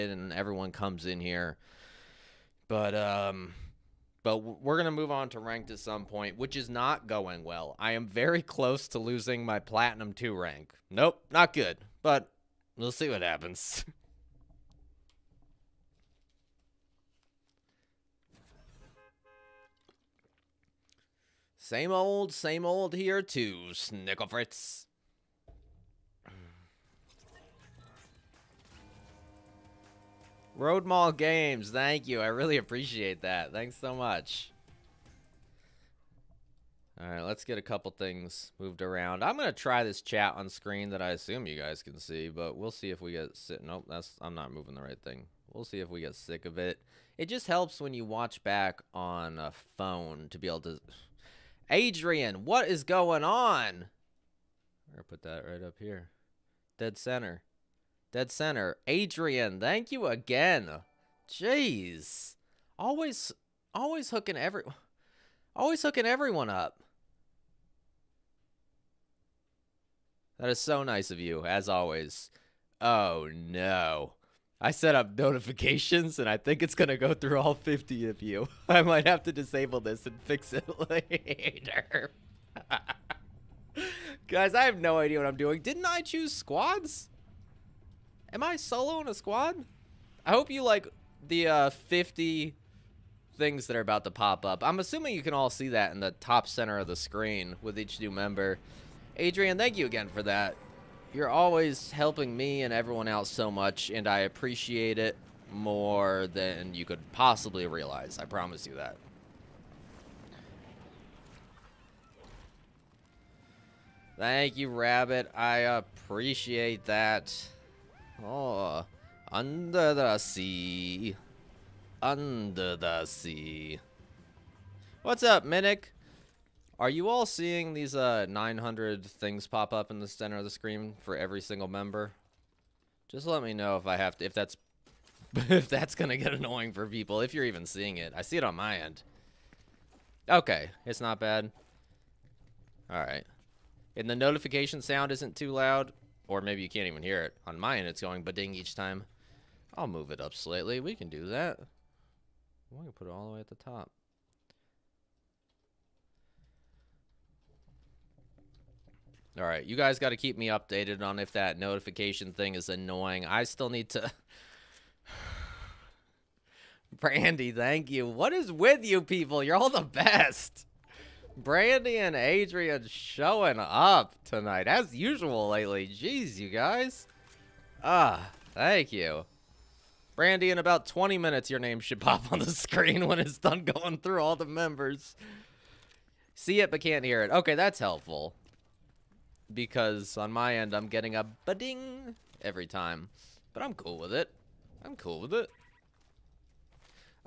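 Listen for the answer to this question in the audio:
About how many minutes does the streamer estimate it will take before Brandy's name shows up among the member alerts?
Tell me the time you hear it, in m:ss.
3:00.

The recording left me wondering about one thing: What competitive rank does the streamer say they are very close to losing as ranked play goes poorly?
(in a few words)
Platinum 2.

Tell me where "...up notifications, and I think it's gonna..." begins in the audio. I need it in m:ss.
1:14.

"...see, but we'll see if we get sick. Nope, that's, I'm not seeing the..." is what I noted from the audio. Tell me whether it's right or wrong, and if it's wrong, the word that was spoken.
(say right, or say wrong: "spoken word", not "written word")
wrong: "moving", not "seeing".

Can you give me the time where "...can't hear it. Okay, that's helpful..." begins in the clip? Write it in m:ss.
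3:06.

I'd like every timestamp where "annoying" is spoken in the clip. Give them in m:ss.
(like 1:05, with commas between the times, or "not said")
2:16, 2:42.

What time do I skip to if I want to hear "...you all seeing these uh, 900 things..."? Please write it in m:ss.
2:06.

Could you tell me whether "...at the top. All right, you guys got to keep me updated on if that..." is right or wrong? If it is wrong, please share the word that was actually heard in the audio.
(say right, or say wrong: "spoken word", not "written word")
right.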